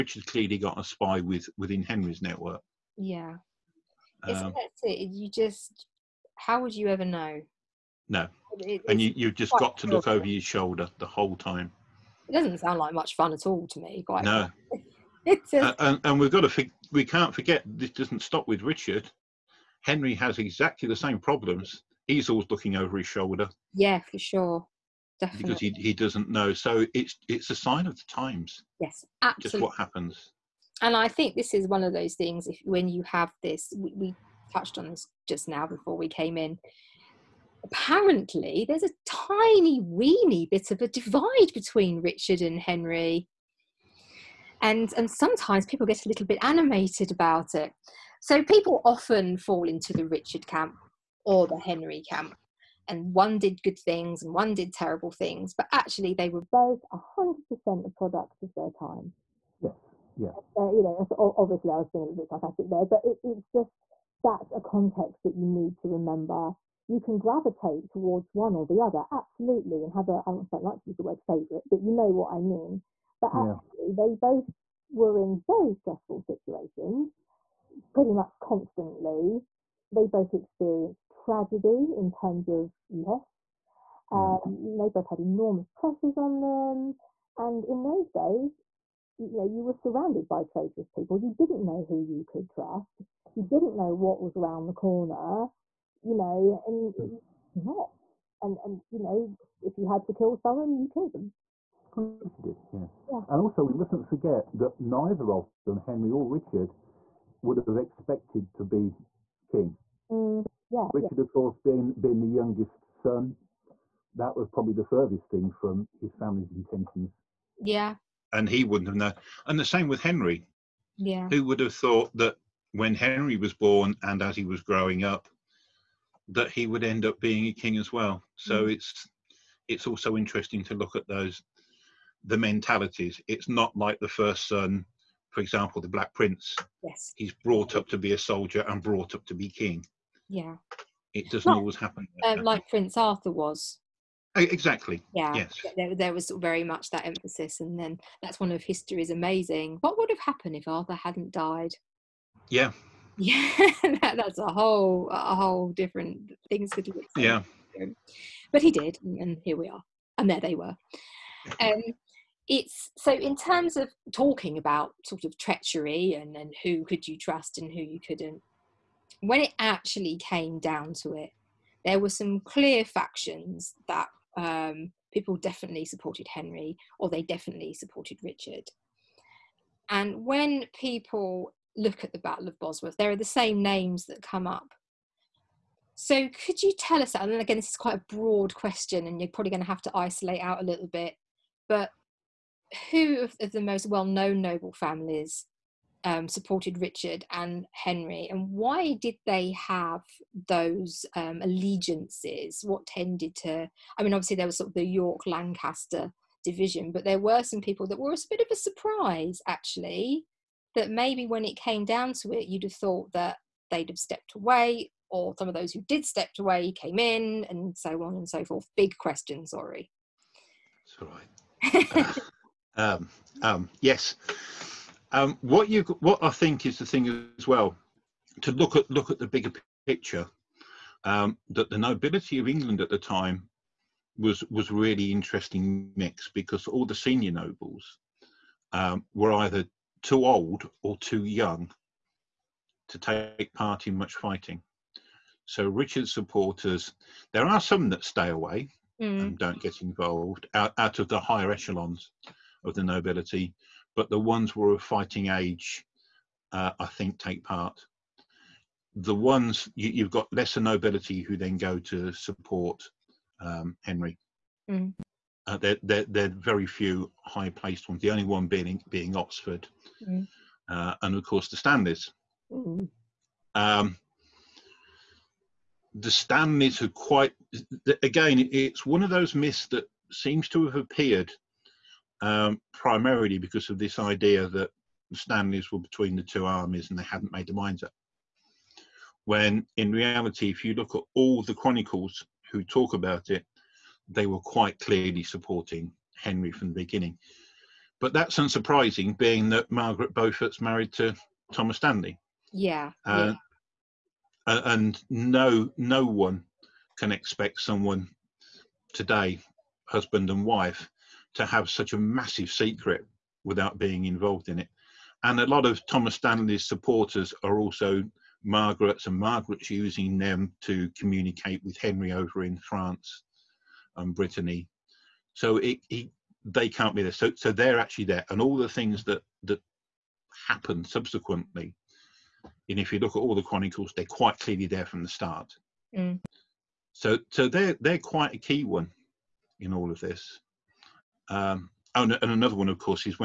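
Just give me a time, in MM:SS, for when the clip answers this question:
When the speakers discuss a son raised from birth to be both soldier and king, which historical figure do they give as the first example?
02:15.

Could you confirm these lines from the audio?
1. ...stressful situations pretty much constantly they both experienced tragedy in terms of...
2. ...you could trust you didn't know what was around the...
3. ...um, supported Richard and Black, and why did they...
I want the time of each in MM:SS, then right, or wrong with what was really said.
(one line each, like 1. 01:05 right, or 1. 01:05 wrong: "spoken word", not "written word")
1. 01:15 right
2. 01:32 right
3. 03:16 wrong: "Henry", not "Black".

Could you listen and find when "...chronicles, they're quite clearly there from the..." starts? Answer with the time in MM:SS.
05:33.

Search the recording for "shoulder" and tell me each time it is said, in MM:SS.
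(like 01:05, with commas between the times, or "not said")
00:10, 00:23.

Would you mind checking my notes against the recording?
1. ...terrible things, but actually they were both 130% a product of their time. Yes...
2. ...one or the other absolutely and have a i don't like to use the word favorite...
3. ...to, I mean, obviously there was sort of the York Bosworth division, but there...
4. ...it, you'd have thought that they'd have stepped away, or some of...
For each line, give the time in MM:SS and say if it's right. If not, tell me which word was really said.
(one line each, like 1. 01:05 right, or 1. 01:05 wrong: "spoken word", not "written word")
1. 00:54 wrong: "100", not "130"
2. 01:08 right
3. 03:23 wrong: "Lancaster", not "Bosworth"
4. 03:32 right.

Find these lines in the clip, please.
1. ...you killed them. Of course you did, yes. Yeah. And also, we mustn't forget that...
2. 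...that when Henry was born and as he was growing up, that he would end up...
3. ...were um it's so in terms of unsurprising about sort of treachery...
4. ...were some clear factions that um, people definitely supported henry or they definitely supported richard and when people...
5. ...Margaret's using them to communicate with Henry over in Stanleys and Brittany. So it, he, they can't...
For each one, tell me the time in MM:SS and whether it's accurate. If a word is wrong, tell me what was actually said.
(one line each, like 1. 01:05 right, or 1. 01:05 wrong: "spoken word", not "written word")
1. 01:40 right
2. 02:02 right
3. 02:40 wrong: "talking", not "unsurprising"
4. 02:51 right
5. 05:19 wrong: "France", not "Stanleys".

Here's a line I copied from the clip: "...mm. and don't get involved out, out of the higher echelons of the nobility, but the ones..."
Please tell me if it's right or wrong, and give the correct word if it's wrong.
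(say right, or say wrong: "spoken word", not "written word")
right.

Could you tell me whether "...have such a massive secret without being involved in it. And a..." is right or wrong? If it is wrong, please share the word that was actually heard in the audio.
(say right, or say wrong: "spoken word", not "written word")
right.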